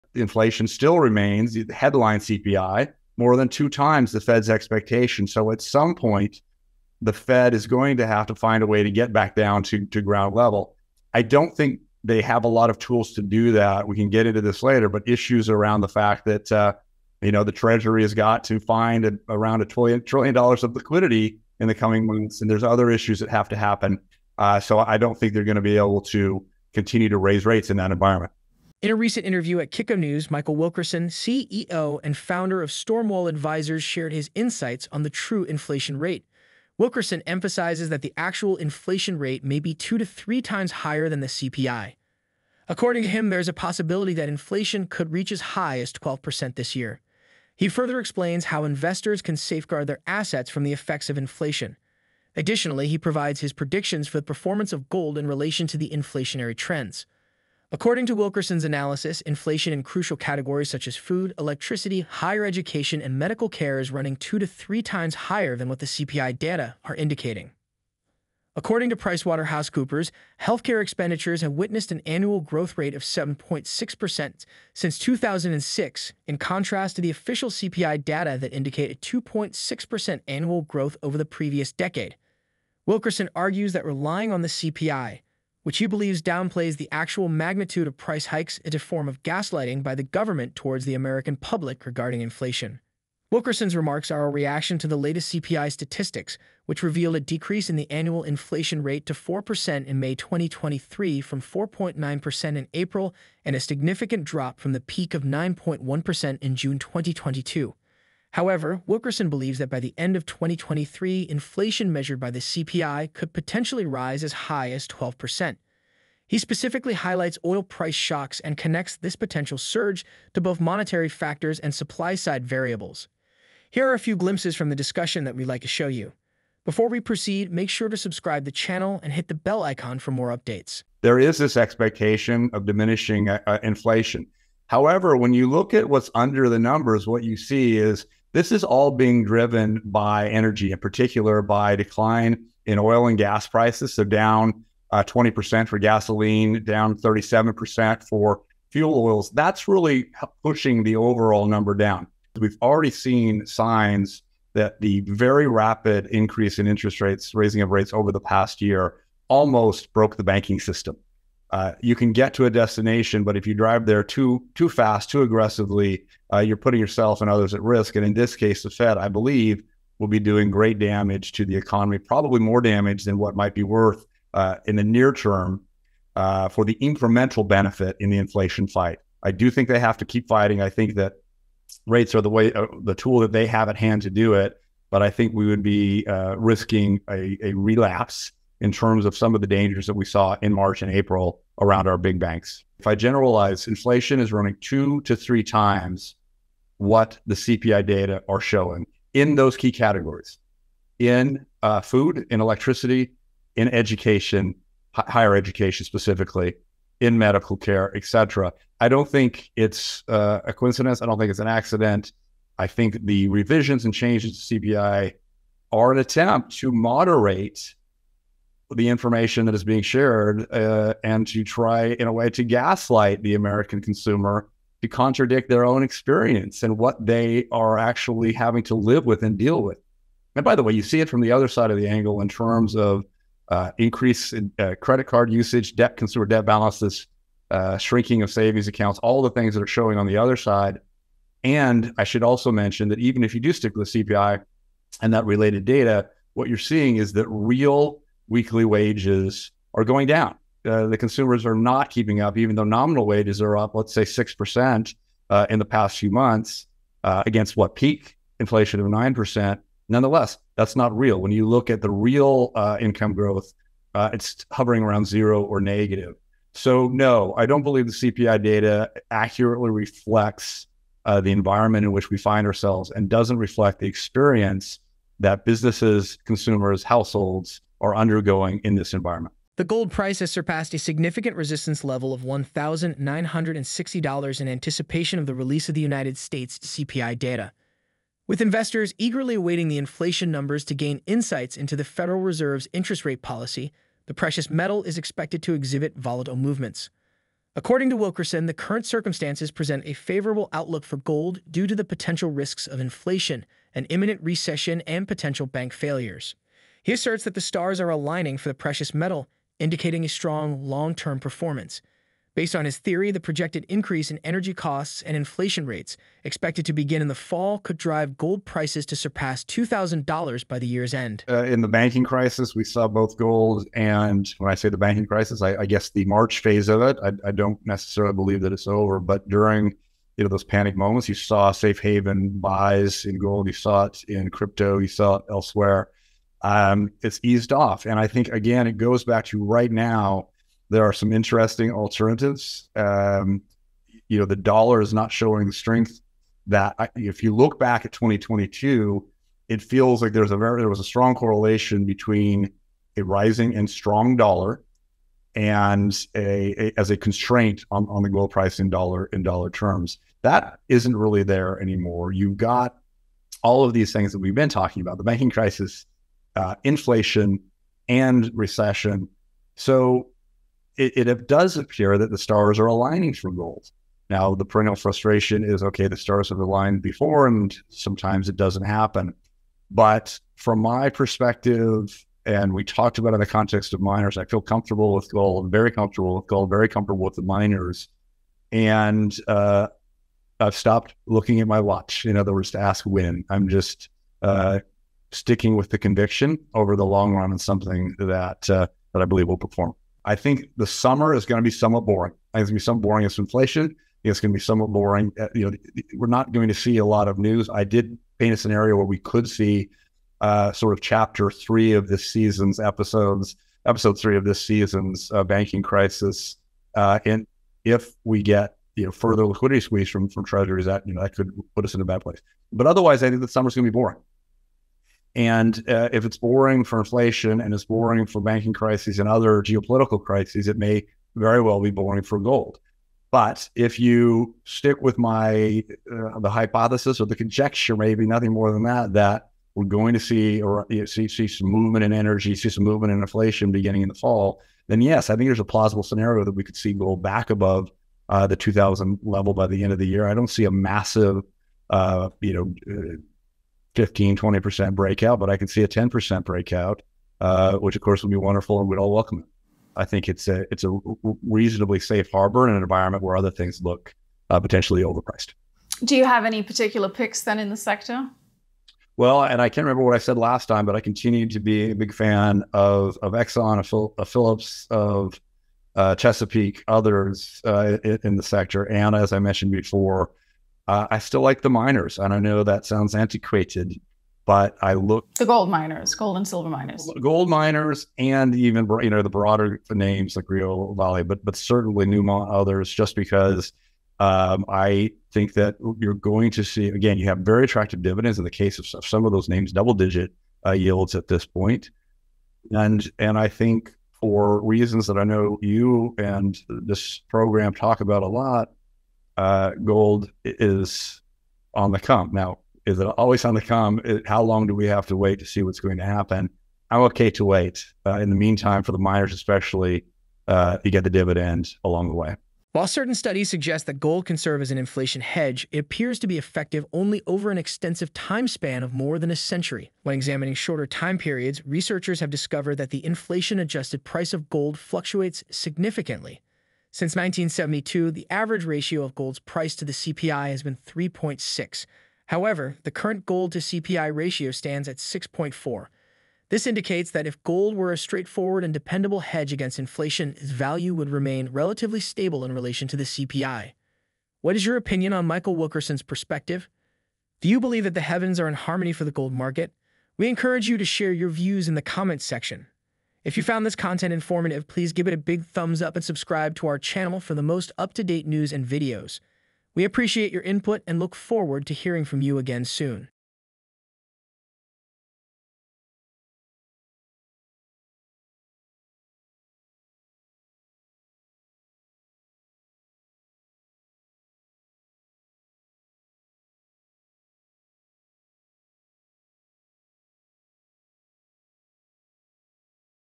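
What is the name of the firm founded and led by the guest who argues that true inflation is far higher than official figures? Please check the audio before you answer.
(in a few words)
Stormwall Advisors.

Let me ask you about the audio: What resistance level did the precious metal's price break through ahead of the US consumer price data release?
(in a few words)
$1,960.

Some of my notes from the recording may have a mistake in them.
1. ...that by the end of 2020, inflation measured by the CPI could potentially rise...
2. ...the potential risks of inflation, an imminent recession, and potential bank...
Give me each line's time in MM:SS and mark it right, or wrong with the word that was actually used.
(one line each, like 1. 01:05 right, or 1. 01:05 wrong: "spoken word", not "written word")
1. 01:49 wrong: "2023", not "2020"
2. 05:01 right.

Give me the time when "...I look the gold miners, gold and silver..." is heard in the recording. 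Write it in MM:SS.
08:04.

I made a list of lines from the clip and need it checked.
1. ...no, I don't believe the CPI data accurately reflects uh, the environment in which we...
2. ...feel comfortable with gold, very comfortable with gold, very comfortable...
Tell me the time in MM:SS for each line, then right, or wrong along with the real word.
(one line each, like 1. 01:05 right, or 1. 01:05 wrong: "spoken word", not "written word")
1. 04:26 right
2. 06:24 right.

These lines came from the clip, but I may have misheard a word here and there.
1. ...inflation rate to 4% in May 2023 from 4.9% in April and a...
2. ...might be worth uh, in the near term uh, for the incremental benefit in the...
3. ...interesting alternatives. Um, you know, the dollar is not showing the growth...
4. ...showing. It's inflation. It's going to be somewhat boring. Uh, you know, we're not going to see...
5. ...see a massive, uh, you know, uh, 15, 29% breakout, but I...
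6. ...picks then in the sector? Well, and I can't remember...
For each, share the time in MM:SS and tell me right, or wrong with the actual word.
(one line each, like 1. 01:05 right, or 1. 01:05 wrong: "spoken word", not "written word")
1. 01:38 right
2. 02:53 right
3. 05:41 wrong: "strength", not "growth"
4. 06:42 wrong: "boring", not "showing"
5. 07:30 wrong: "20", not "29"
6. 07:46 right.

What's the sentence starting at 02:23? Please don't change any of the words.
So down uh, 20% for gasoline, down 37% for fuel oils.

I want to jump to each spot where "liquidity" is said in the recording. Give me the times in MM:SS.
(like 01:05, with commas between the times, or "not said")
00:20, 06:59.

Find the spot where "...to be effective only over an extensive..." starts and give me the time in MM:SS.
08:45.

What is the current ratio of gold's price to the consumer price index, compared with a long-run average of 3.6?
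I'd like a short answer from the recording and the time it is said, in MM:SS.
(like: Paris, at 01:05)
6.4, at 09:04.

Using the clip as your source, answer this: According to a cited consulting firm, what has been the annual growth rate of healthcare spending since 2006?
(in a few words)
7.6%.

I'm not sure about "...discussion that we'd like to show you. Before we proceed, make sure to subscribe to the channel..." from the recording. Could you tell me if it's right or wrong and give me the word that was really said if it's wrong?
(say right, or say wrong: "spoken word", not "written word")
right.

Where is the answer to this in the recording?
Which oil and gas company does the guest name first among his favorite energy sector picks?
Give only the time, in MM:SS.
07:53.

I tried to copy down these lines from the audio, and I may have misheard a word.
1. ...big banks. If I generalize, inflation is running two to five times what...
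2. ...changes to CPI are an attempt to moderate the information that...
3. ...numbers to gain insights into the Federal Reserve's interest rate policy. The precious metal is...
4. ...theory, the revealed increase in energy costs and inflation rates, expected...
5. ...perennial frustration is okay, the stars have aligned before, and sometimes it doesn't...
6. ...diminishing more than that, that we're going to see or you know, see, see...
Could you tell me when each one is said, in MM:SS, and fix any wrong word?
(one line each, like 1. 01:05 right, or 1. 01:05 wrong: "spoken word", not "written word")
1. 03:11 wrong: "three", not "five"
2. 03:33 right
3. 04:50 right
4. 05:12 wrong: "projected", not "revealed"
5. 06:14 right
6. 07:18 wrong: "nothing", not "diminishing".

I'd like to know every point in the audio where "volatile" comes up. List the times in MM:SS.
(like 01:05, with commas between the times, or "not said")
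04:55.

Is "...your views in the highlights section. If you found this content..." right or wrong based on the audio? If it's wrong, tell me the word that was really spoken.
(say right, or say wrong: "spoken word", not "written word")
wrong: "comments", not "highlights".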